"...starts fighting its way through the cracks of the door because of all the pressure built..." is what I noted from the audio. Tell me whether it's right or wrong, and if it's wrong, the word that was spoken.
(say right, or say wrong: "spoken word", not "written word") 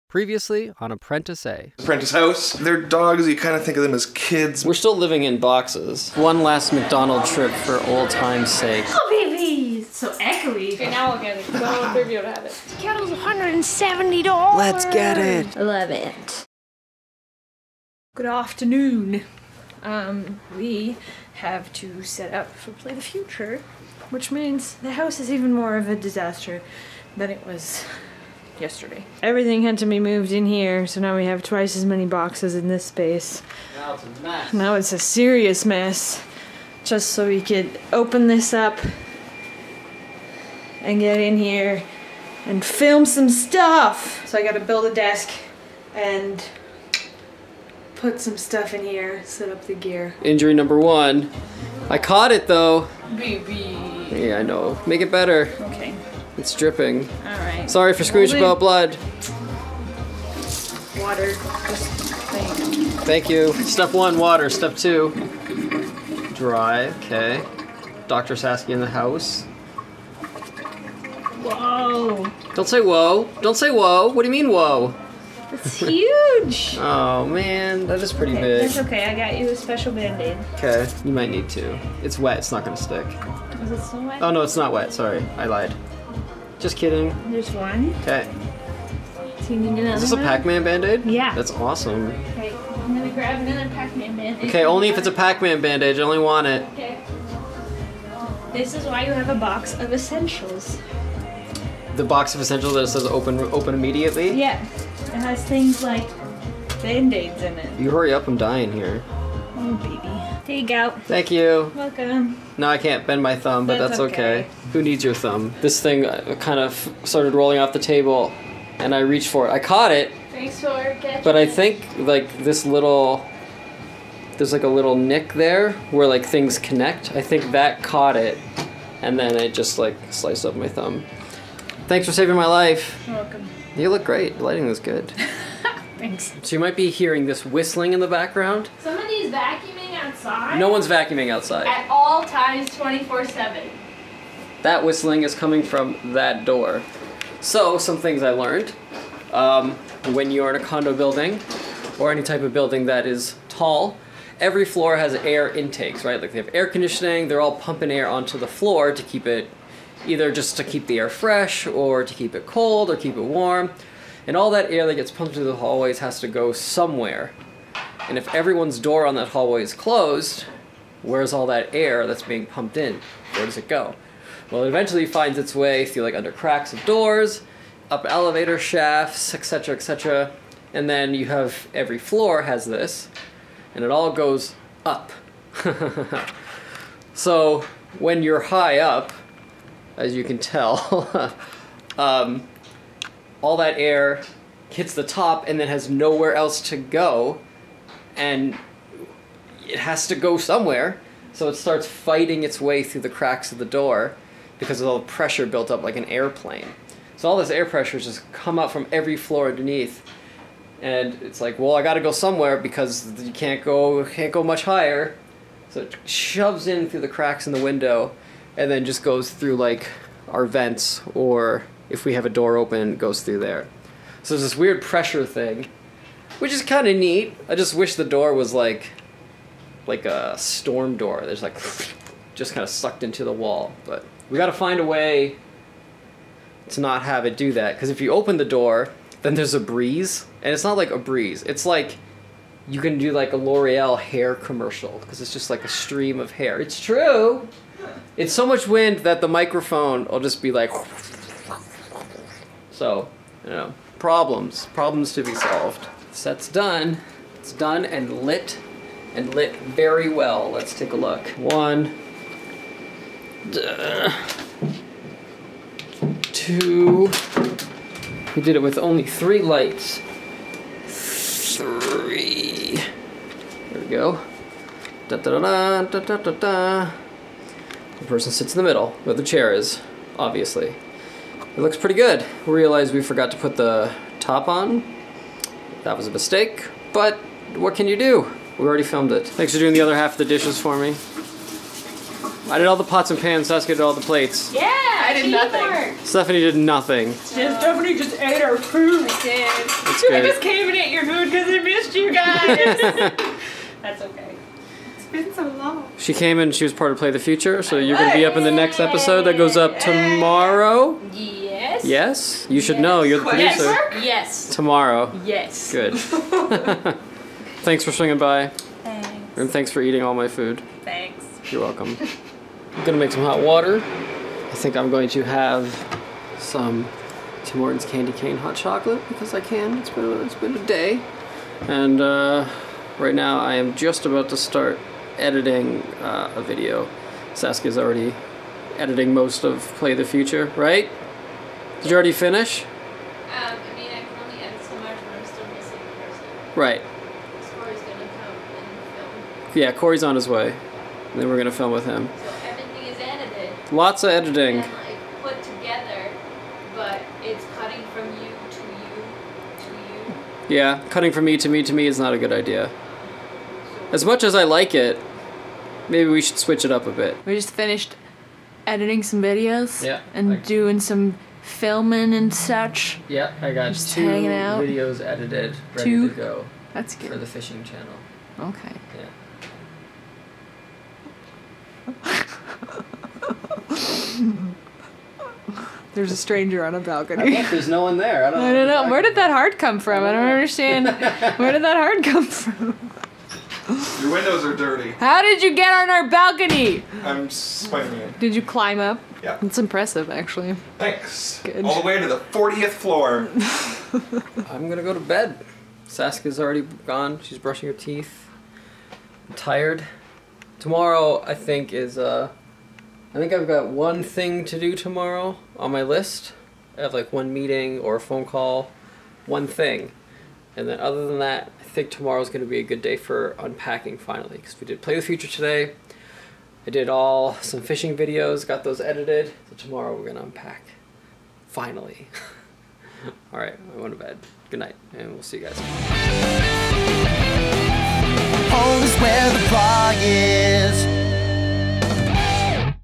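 right.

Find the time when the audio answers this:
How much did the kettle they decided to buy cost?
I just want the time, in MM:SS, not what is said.
00:13.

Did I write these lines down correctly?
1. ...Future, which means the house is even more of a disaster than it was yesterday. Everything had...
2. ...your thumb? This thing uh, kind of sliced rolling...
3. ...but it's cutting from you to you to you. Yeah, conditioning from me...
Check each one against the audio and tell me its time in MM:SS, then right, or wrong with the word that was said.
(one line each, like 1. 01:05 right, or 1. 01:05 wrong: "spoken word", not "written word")
1. 00:23 right
2. 01:55 wrong: "started", not "sliced"
3. 05:56 wrong: "cutting", not "conditioning".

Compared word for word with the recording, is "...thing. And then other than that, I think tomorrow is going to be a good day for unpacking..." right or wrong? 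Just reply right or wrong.
right.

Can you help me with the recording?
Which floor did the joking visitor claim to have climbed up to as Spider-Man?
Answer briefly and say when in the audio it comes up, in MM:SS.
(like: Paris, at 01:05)
40th floor, at 06:42.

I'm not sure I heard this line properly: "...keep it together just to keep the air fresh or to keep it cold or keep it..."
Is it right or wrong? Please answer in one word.
wrong.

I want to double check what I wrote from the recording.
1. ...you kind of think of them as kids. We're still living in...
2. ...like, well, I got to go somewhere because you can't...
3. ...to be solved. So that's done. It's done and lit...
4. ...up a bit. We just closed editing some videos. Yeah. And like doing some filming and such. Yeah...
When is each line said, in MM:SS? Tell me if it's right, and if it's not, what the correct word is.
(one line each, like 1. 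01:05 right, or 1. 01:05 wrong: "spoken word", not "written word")
1. 00:03 right
2. 03:31 right
3. 04:15 right
4. 06:06 wrong: "finished", not "closed".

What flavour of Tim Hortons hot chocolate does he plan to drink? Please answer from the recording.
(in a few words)
Candy Cane.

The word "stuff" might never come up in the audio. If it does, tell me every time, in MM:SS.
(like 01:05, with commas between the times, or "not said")
00:43, 00:48.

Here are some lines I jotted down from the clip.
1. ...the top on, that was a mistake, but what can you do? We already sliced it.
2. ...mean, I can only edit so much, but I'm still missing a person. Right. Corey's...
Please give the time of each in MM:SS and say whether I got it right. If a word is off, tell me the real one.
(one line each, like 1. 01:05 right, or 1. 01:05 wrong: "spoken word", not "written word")
1. 04:43 wrong: "filmed", not "sliced"
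2. 05:43 right.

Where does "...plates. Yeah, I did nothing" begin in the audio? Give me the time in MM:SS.
04:54.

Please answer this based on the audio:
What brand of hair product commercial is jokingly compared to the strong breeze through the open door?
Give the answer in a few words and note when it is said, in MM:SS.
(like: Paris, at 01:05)
L'Oreal, at 04:03.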